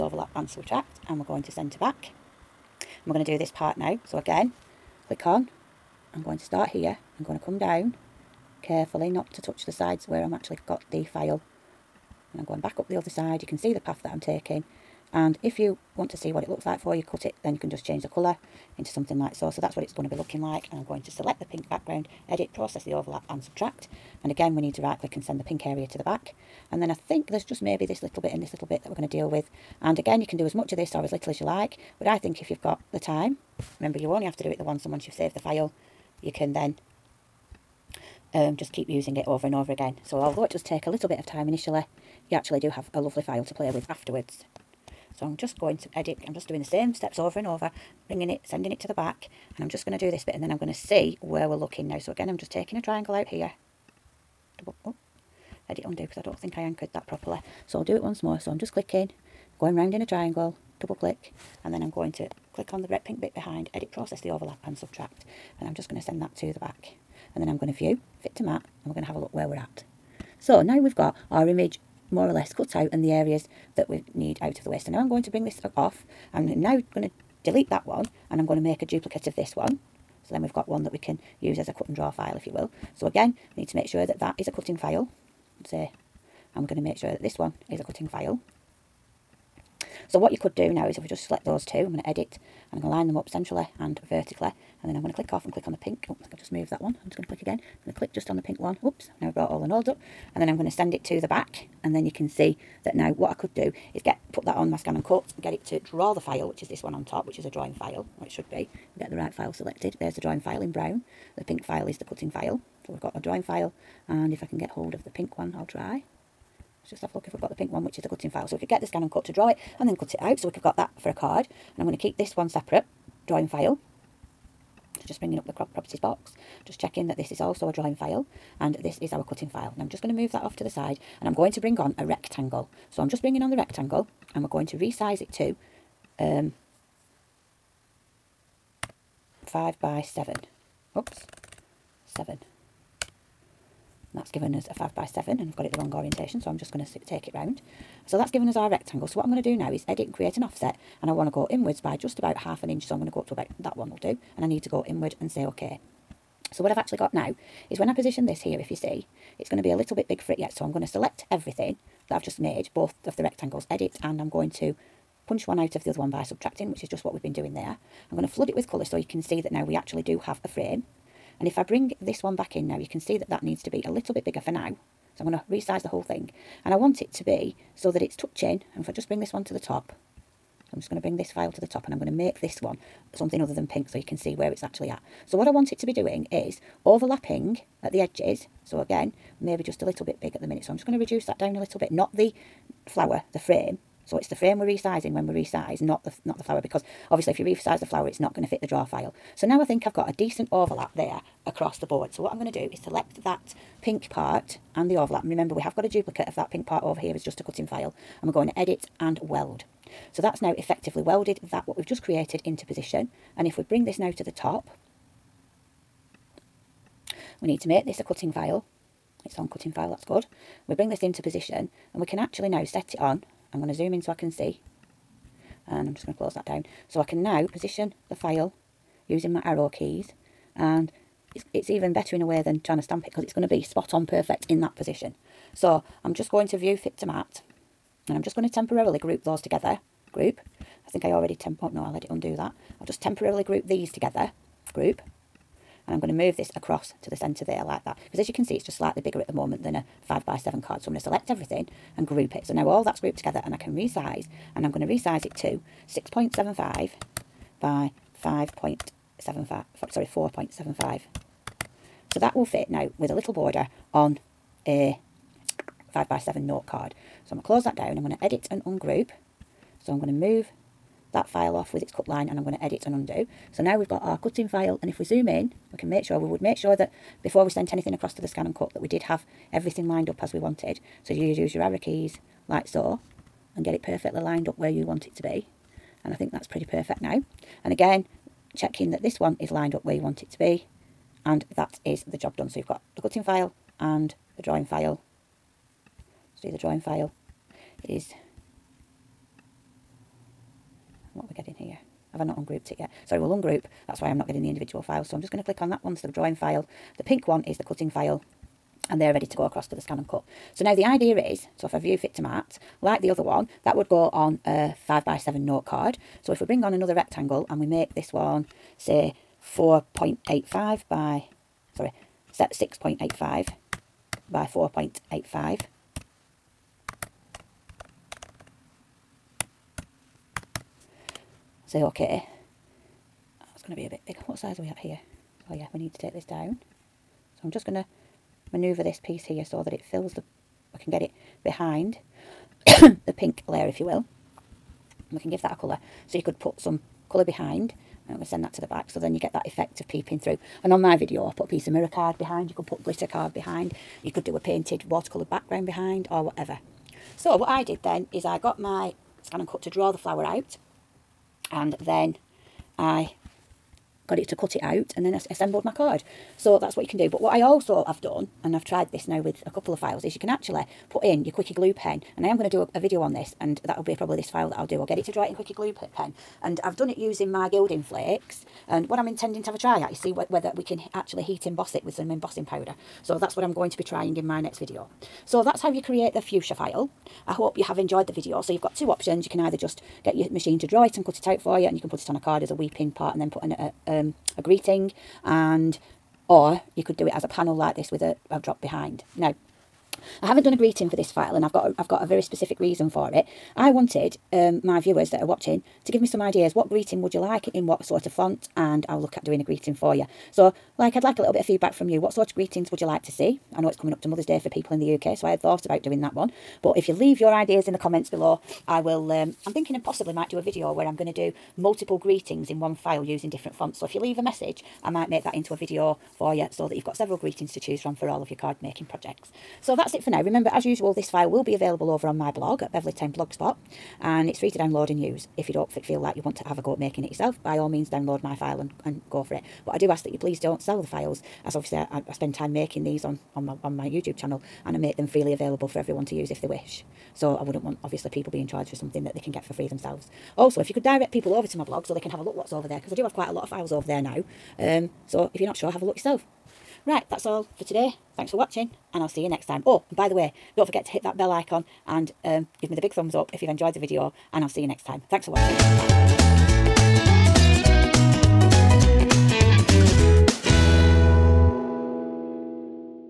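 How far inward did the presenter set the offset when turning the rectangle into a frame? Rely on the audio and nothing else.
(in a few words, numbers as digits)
half an inch.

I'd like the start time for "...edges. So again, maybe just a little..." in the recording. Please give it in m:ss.
3:08.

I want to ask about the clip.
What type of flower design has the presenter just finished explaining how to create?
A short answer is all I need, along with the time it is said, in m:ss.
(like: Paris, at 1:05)
fuchsia, at 6:26.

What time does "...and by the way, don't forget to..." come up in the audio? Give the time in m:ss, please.
7:39.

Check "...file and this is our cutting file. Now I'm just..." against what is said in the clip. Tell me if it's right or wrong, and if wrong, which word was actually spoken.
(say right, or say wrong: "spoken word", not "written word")
right.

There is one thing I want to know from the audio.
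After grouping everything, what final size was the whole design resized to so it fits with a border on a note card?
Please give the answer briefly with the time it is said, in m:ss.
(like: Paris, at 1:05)
6.75 by 4.75, at 4:15.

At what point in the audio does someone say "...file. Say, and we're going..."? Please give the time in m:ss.
1:24.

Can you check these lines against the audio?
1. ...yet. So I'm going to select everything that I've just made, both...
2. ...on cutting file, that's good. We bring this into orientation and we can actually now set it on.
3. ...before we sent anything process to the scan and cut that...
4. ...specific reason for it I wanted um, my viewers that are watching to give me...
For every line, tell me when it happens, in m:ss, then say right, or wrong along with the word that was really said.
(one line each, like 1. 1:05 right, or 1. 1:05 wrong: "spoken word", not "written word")
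1. 2:40 right
2. 3:39 wrong: "position", not "orientation"
3. 4:37 wrong: "across", not "process"
4. 6:42 right.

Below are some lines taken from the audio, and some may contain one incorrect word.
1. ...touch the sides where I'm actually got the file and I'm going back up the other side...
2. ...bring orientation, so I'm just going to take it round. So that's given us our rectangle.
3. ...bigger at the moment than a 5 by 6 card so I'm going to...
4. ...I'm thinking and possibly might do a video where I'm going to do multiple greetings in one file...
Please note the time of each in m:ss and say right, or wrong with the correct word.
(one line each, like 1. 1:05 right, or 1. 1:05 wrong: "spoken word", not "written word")
1. 0:09 right
2. 2:25 wrong: "wrong", not "bring"
3. 4:09 wrong: "7", not "6"
4. 6:59 right.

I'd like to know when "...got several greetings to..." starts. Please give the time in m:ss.
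7:06.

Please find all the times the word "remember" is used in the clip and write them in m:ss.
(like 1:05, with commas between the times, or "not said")
0:33, 3:25, 7:10.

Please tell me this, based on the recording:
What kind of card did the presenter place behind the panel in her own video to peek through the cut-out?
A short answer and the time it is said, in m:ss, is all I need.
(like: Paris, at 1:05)
mirror card, at 5:51.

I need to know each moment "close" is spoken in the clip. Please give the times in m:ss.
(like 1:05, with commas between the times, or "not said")
3:46, 4:27.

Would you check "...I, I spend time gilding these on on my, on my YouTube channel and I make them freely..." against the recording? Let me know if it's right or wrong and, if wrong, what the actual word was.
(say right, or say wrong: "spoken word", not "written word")
wrong: "making", not "gilding".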